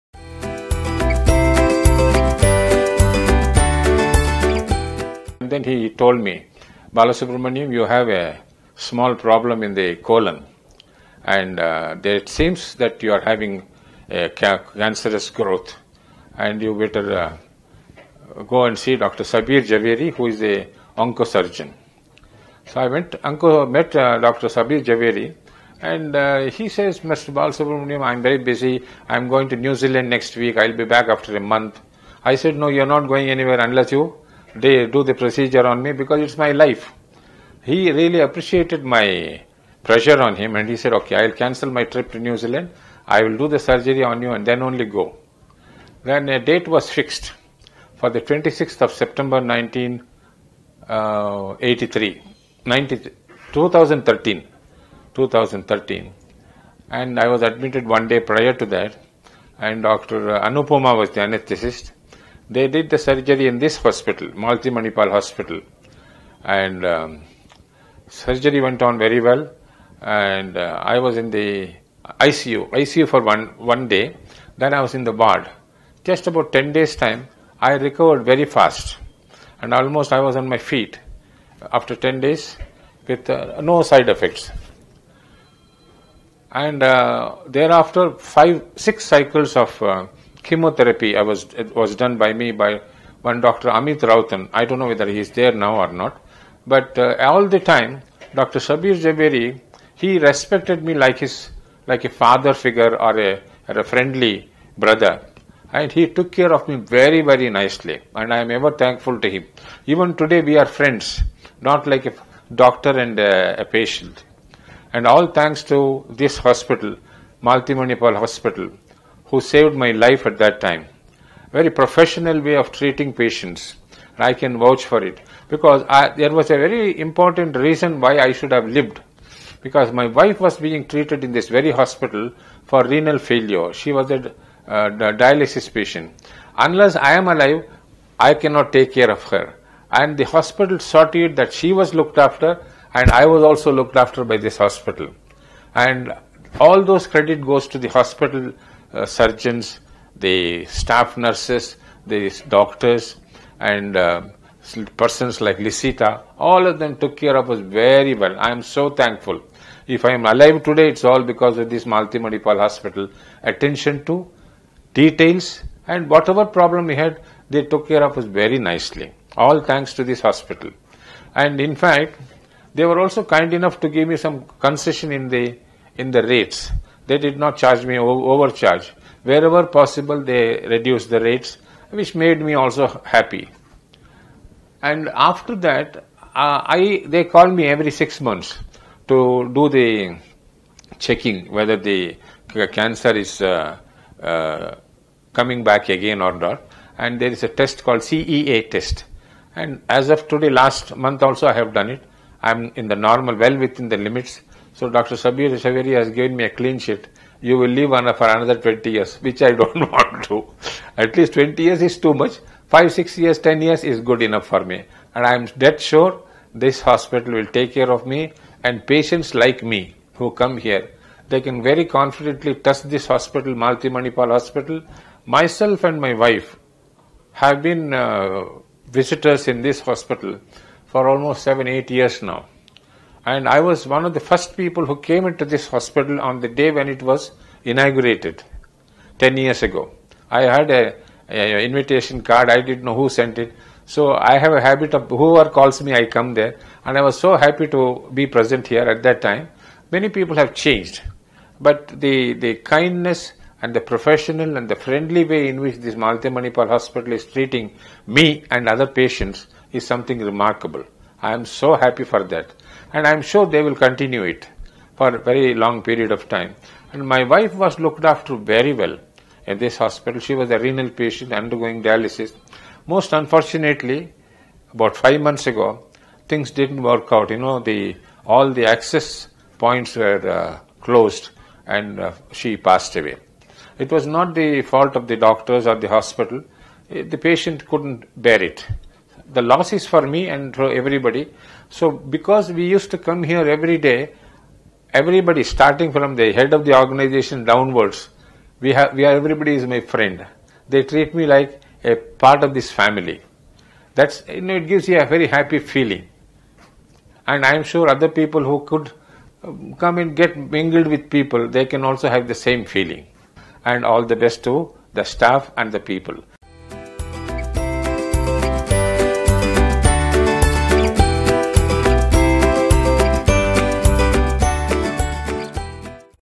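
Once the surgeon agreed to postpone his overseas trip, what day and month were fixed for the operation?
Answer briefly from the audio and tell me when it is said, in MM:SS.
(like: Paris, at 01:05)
26 September, at 00:48.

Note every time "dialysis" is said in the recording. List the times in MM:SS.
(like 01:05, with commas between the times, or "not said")
02:15, 04:31.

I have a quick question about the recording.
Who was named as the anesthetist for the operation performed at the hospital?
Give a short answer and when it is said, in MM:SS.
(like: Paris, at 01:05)
Dr. Anupoma, at 00:59.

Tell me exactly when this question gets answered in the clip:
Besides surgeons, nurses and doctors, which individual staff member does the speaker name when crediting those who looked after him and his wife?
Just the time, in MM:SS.
02:35.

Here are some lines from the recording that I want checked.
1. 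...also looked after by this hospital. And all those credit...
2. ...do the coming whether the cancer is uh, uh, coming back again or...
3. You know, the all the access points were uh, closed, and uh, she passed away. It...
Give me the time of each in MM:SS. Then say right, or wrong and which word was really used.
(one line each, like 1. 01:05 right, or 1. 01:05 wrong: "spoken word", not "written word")
1. 02:23 right
2. 03:09 wrong: "checking", not "coming"
3. 04:37 right.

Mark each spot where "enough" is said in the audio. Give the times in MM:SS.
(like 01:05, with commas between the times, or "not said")
02:53, 03:34.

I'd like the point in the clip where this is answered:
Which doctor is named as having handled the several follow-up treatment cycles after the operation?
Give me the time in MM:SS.
01:33.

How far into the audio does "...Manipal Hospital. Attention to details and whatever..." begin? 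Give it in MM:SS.
02:42.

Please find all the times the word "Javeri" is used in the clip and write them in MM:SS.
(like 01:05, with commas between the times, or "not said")
00:19, 00:24, 01:39.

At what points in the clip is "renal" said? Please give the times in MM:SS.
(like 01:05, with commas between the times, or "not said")
02:12, 04:30.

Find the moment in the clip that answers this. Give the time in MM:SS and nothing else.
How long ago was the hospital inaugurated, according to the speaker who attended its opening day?
03:59.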